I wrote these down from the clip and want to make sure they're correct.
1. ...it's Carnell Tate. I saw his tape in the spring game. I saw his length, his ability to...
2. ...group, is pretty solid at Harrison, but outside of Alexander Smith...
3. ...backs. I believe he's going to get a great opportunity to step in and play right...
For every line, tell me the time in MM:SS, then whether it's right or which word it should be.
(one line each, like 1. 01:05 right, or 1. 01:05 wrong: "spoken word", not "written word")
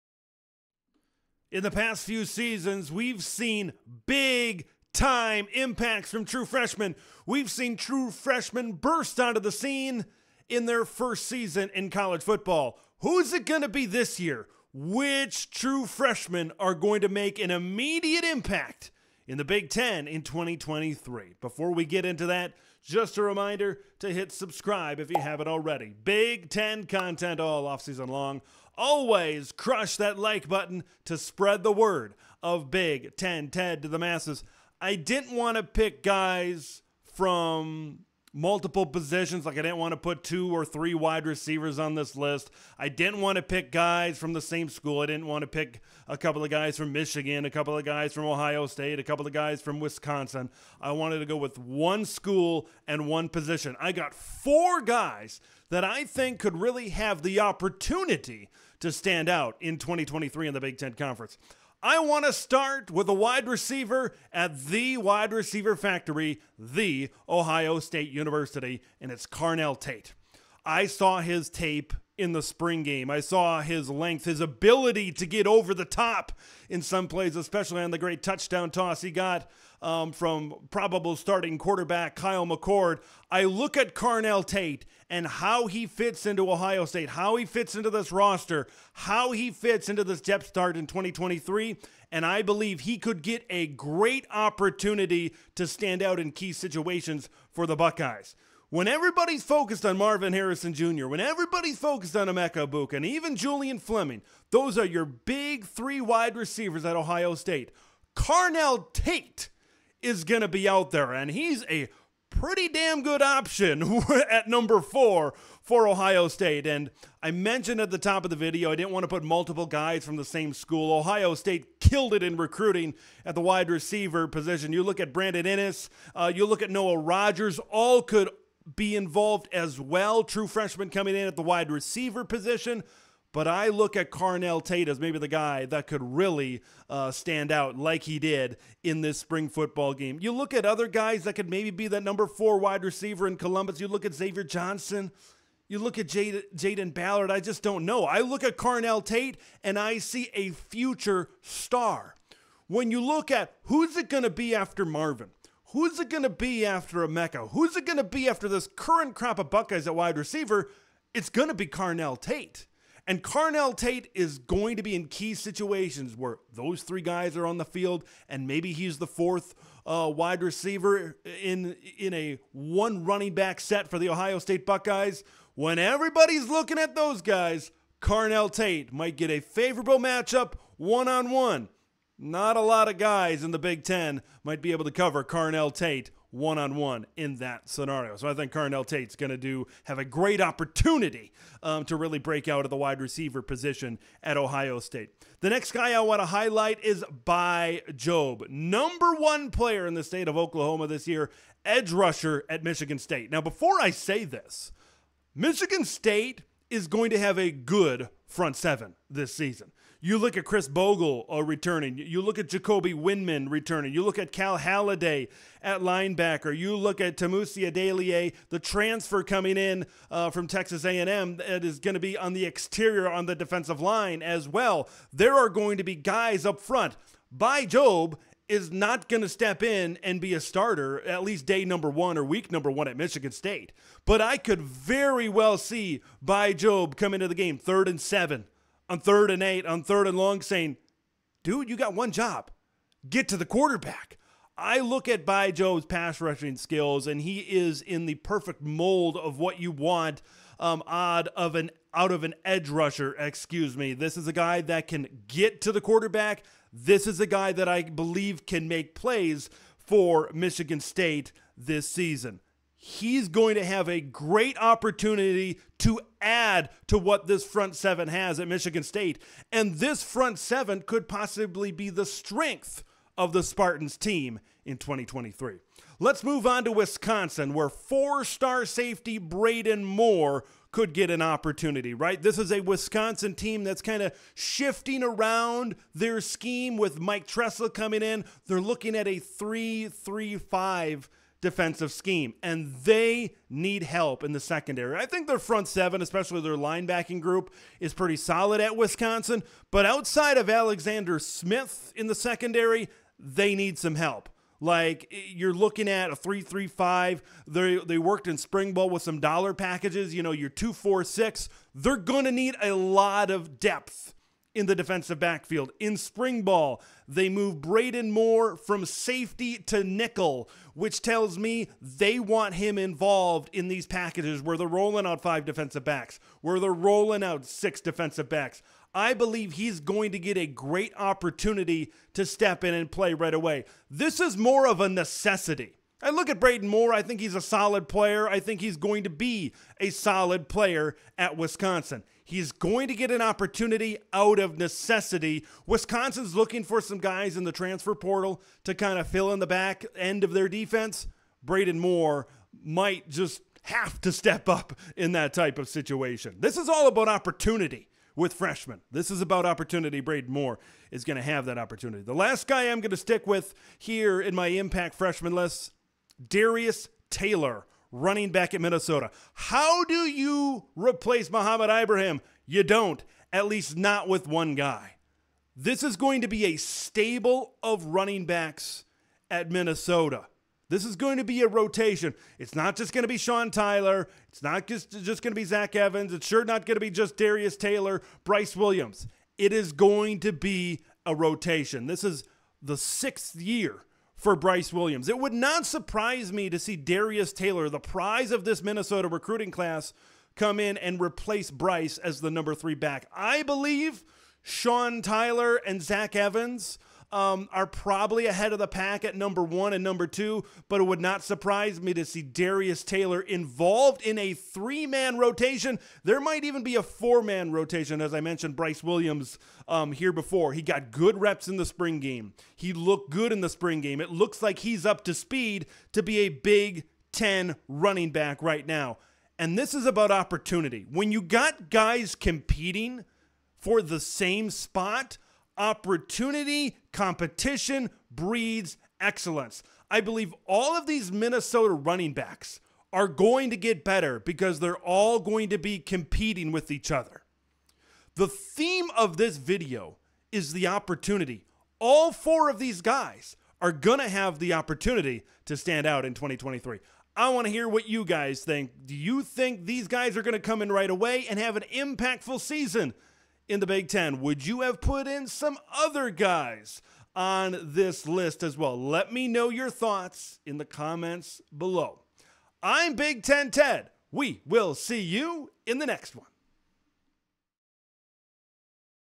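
1. 01:09 right
2. 04:57 wrong: "Wisconsin", not "Harrison"
3. 05:28 right.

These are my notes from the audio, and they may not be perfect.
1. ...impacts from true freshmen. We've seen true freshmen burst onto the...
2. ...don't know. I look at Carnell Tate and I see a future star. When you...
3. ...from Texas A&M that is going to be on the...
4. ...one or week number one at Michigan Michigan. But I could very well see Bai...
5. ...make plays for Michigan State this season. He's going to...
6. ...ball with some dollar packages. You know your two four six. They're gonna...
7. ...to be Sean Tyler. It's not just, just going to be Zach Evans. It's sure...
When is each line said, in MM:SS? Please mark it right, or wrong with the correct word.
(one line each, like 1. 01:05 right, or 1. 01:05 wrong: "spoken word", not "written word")
1. 00:05 right
2. 02:27 right
3. 03:40 right
4. 03:51 wrong: "State", not "Michigan"
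5. 04:18 right
6. 05:08 right
7. 06:23 right.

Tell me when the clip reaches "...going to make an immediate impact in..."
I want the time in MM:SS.
00:16.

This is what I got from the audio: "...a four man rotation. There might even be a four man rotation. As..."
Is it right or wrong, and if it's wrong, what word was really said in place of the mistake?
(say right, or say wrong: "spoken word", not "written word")
wrong: "three", not "four".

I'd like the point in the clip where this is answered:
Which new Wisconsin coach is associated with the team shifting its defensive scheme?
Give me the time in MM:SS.
04:46.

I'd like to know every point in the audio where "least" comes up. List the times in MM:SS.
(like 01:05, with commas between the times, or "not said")
03:51, 06:13.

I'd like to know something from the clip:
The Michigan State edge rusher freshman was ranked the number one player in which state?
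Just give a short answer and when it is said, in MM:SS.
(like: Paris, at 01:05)
Oklahoma, at 03:20.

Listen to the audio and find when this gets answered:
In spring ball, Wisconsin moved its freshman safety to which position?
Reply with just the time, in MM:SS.
05:19.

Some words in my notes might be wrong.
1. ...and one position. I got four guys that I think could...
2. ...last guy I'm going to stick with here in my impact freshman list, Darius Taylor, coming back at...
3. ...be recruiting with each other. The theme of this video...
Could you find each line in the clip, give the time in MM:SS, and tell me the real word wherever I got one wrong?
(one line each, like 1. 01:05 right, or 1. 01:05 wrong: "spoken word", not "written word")
1. 00:52 right
2. 06:02 wrong: "running", not "coming"
3. 07:25 wrong: "competing", not "recruiting".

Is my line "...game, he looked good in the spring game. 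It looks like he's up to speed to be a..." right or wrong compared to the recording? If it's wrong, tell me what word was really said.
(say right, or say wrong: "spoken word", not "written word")
right.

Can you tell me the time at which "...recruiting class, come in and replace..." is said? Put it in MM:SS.
06:39.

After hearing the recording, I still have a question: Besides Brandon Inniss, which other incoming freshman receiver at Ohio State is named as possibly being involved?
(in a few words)
Noah Rogers.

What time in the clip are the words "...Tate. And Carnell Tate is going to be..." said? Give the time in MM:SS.
02:42.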